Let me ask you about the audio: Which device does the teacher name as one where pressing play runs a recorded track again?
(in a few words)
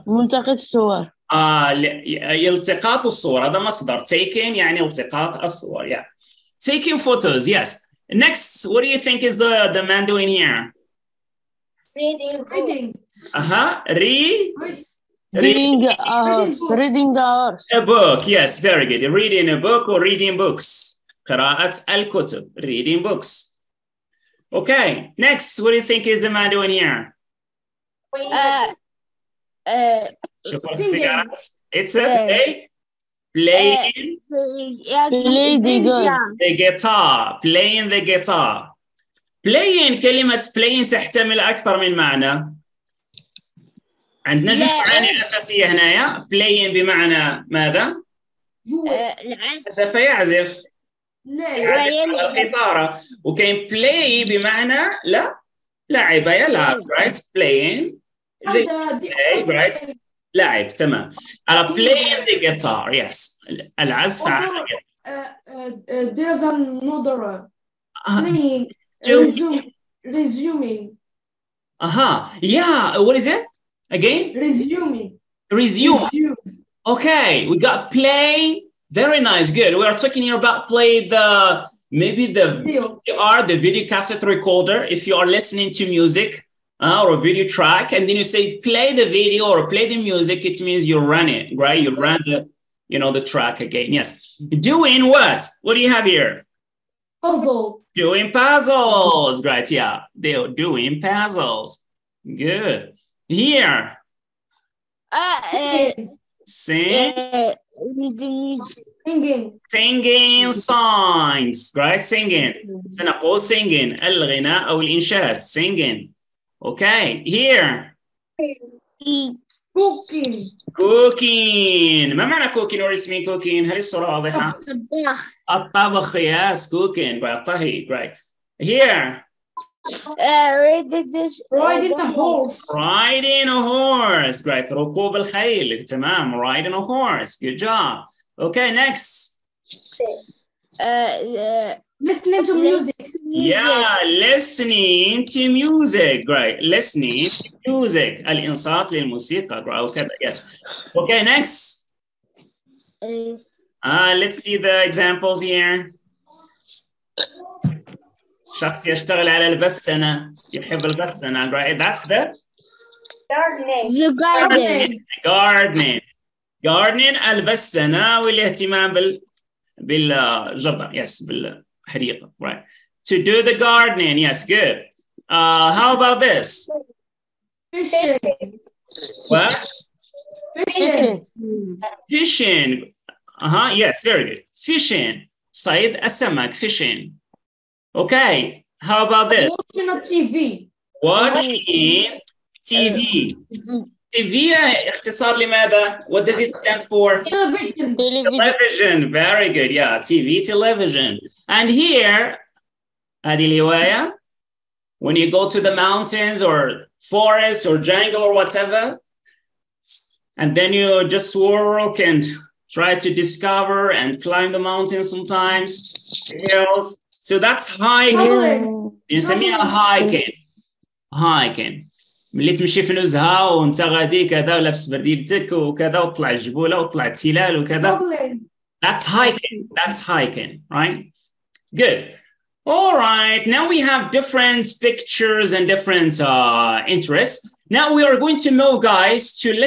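video cassette recorder.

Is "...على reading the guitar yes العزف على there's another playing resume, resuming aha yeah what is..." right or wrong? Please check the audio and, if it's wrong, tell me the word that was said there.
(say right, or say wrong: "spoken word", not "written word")
wrong: "playing", not "reading".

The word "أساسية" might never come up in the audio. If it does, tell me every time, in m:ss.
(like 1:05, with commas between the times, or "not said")
0:45.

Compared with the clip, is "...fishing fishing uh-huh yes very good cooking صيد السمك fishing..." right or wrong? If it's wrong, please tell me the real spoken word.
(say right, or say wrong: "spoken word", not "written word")
wrong: "fishing", not "cooking".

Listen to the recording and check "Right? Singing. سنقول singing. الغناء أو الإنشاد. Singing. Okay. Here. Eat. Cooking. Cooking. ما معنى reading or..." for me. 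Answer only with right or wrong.
wrong.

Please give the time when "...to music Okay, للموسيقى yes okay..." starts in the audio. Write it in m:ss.
2:27.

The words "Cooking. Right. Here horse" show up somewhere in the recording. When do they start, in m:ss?
2:06.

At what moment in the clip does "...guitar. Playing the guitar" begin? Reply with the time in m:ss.
0:36.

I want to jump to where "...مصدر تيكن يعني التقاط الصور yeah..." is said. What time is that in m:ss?
0:03.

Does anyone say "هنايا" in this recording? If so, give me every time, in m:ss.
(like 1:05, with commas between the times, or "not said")
0:45.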